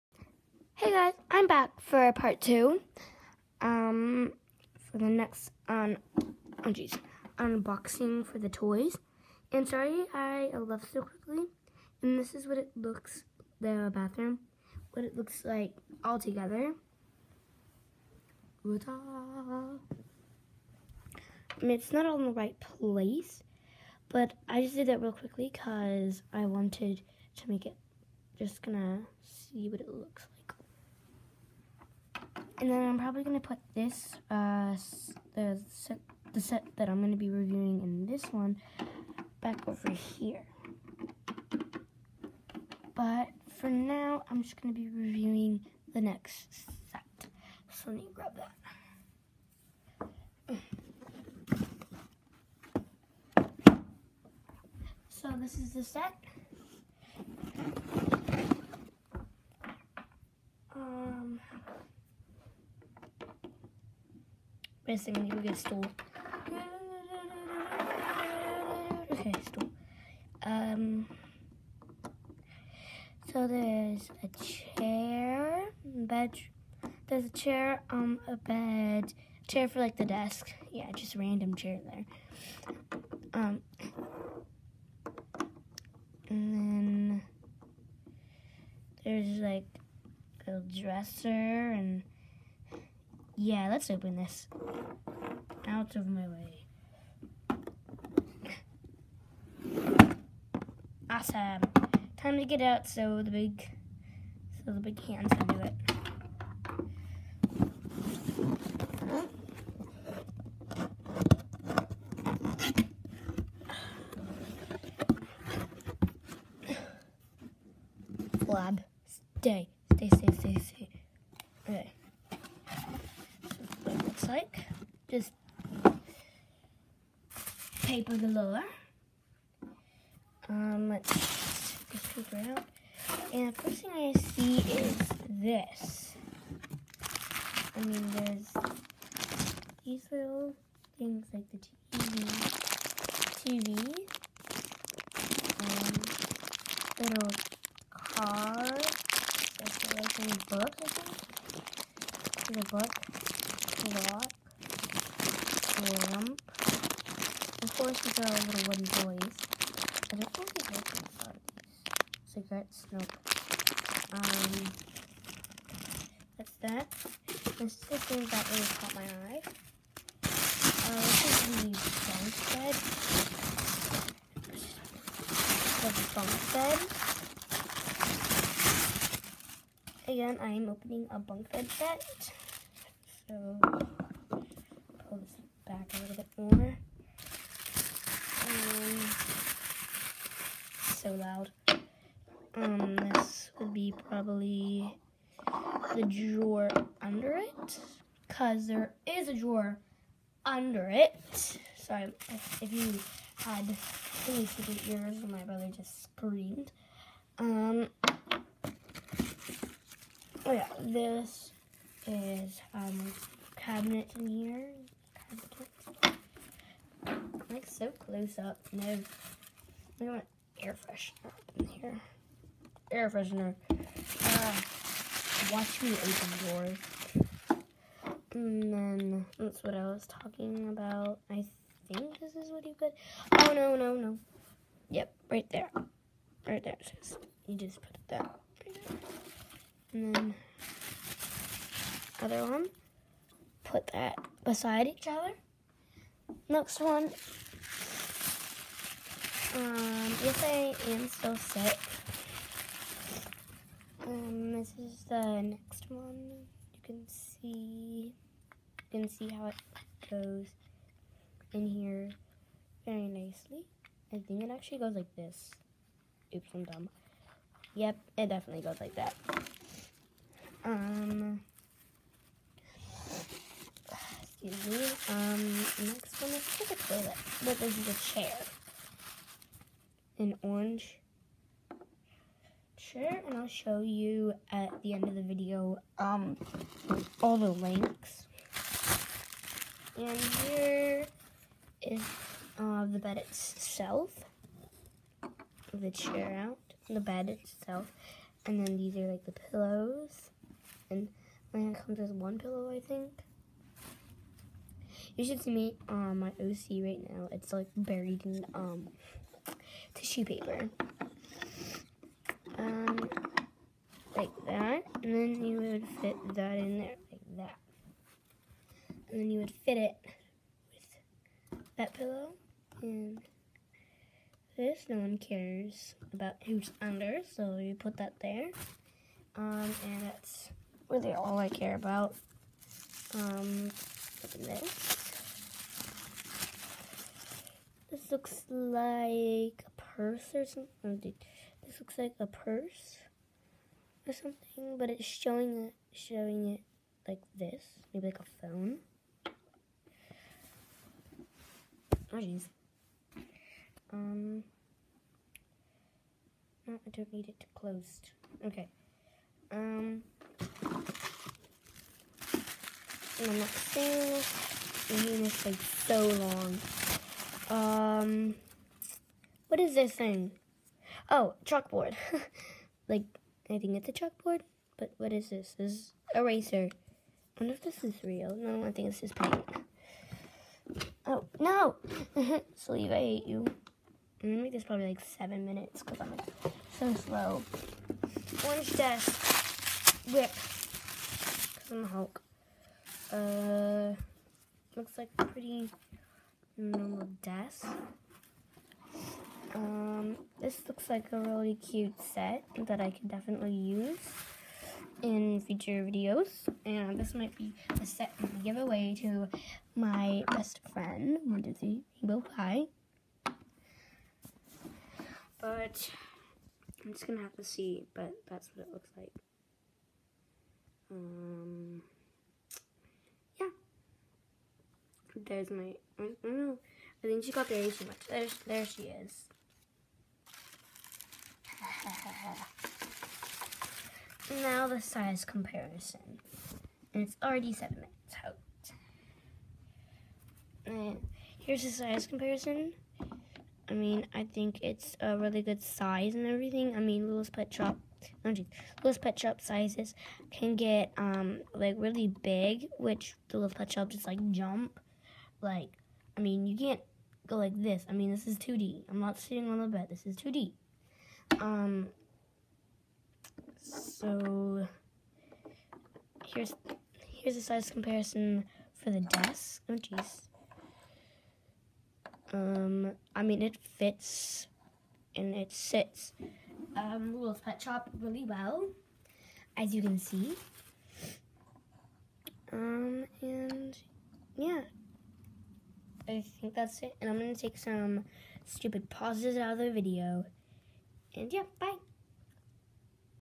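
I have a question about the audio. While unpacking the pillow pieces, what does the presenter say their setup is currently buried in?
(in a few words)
Tissue paper.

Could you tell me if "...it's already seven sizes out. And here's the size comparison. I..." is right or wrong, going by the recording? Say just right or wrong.
wrong.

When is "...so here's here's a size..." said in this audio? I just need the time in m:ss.
7:44.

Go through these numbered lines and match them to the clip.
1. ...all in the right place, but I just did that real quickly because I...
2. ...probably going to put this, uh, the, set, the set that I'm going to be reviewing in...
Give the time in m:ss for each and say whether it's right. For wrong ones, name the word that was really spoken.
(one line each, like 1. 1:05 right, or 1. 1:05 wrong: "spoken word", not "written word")
1. 0:22 right
2. 0:32 right.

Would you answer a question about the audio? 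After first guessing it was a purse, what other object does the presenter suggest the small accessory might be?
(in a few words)
A phone.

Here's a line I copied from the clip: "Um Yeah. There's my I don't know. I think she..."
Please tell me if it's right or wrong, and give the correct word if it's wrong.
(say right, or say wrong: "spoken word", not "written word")
right.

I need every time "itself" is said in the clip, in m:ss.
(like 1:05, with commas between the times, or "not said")
4:53, 4:57.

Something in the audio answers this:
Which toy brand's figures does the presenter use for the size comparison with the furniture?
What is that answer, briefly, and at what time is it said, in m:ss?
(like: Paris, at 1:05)
Littlest Pet Shop, at 7:27.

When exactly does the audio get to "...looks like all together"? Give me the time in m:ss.
0:15.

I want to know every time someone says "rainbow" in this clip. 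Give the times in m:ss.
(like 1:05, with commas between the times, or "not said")
6:52.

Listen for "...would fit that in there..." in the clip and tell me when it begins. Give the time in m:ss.
5:15.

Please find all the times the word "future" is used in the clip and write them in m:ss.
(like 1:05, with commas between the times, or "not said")
6:45.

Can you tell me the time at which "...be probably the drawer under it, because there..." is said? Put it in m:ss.
3:13.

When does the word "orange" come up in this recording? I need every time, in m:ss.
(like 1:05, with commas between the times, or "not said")
4:40, 6:28.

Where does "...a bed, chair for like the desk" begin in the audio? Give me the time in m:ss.
1:18.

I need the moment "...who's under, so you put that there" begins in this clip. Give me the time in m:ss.
5:26.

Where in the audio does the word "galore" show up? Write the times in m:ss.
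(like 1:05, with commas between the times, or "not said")
2:08.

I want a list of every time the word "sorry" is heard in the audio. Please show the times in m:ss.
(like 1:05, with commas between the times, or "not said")
0:09, 3:21.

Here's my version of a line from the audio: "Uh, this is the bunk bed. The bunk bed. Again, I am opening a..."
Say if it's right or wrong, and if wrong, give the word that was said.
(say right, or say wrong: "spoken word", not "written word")
right.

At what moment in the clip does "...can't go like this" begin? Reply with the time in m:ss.
7:36.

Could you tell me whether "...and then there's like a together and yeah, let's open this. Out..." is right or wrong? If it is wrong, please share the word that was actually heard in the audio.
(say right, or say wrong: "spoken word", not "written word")
wrong: "dresser", not "together".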